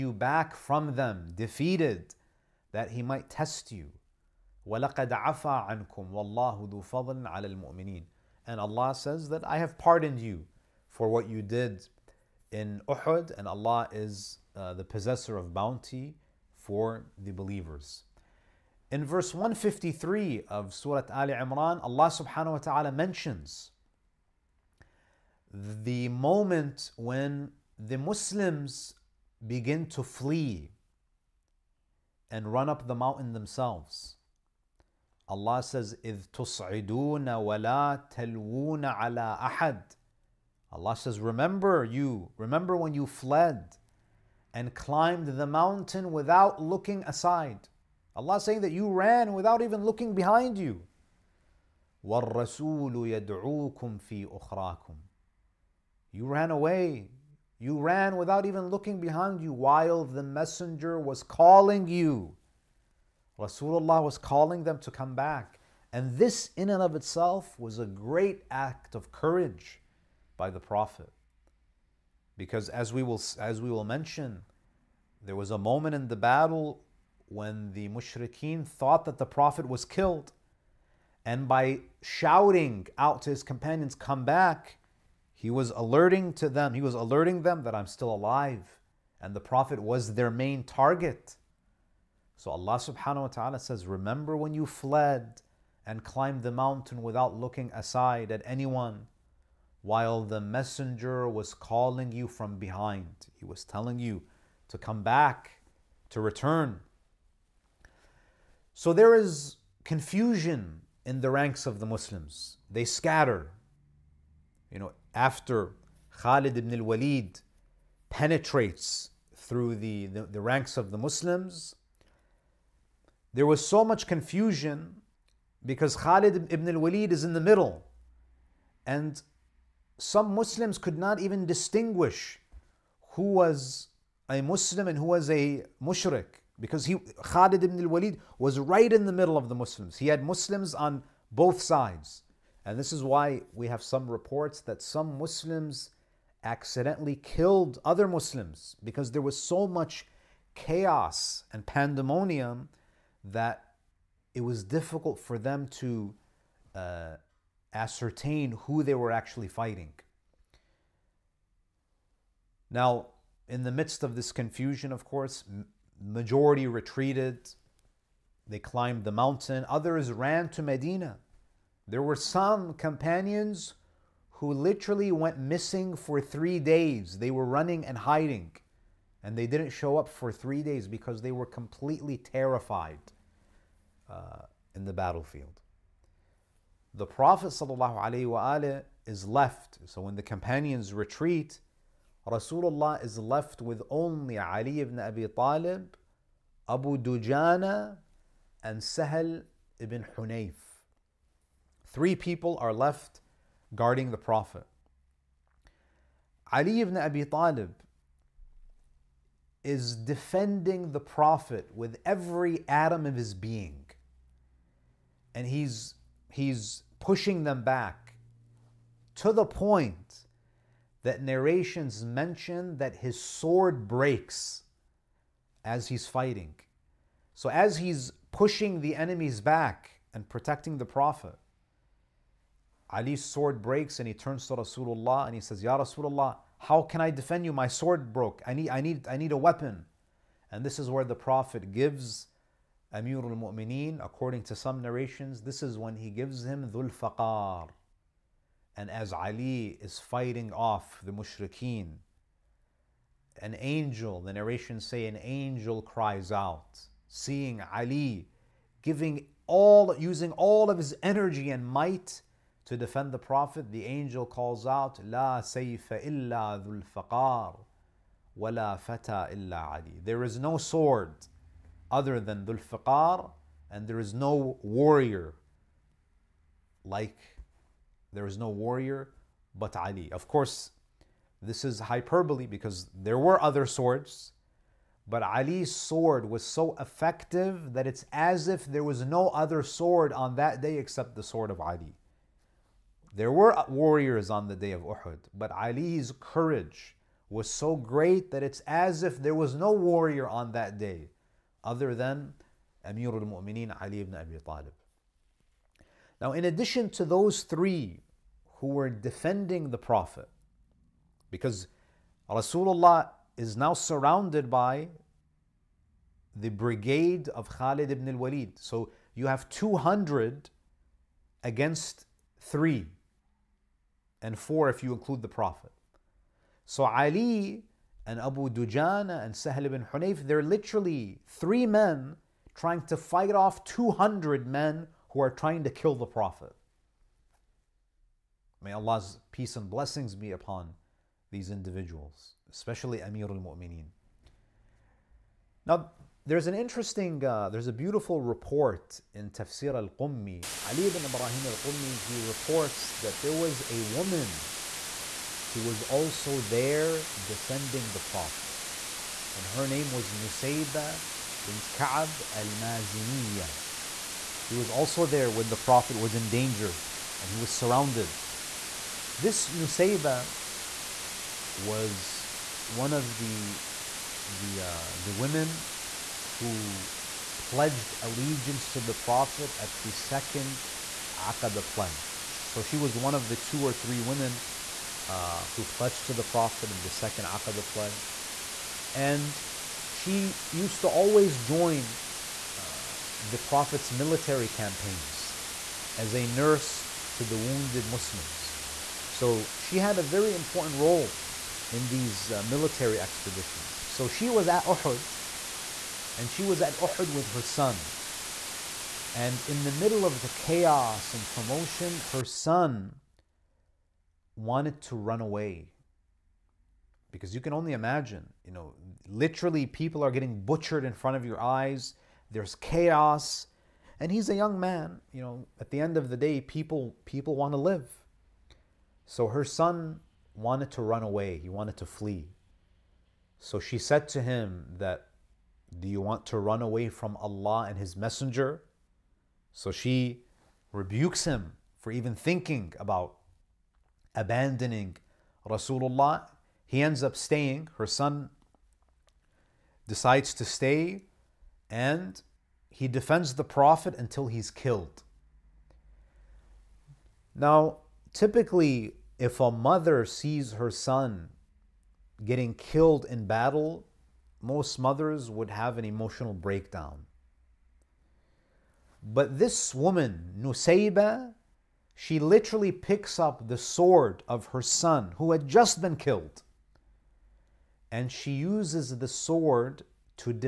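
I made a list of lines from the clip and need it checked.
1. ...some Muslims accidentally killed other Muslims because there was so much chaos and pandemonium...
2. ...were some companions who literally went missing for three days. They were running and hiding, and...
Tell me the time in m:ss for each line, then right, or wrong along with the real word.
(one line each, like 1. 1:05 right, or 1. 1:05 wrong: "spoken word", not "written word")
1. 2:24 right
2. 2:52 right.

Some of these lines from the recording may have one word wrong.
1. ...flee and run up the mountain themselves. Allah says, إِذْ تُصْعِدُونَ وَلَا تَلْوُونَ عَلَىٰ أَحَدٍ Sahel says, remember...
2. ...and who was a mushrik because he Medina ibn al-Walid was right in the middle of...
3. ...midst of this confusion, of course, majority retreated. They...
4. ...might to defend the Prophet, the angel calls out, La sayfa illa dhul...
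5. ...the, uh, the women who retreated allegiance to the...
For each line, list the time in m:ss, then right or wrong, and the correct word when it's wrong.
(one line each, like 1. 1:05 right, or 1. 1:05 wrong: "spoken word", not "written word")
1. 0:30 wrong: "Allah", not "Sahel"
2. 2:14 wrong: "Khalid", not "Medina"
3. 2:43 right
4. 4:21 right
5. 6:14 wrong: "pledged", not "retreated".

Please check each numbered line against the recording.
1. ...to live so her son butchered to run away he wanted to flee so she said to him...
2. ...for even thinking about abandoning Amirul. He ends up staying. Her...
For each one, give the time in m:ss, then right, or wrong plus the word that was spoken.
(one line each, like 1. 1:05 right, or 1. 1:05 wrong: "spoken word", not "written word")
1. 7:07 wrong: "wanted", not "butchered"
2. 7:21 wrong: "Rasulullah", not "Amirul".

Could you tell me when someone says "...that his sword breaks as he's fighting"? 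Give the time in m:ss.
3:42.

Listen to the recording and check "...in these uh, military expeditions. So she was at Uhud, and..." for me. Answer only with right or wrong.
right.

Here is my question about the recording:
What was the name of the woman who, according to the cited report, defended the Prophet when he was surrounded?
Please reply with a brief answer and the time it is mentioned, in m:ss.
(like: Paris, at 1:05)
Nusayba bint Ka'b al Maziniya, at 6:00.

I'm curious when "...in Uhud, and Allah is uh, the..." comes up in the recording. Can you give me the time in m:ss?
0:12.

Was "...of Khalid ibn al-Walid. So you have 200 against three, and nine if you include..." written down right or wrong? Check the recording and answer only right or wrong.
wrong.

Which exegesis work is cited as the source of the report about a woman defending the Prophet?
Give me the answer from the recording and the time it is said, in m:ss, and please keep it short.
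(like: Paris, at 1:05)
Tafsir al Qummi, at 5:49.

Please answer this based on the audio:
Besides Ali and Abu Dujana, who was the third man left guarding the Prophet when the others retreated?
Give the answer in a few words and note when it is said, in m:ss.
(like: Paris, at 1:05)
Sahel ibn Hunayf, at 3:18.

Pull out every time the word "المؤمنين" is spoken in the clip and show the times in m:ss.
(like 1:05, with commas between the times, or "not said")
0:07.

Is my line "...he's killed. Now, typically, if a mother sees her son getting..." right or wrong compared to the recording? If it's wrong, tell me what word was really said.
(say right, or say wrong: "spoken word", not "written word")
right.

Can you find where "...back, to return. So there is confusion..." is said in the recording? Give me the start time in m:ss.
1:45.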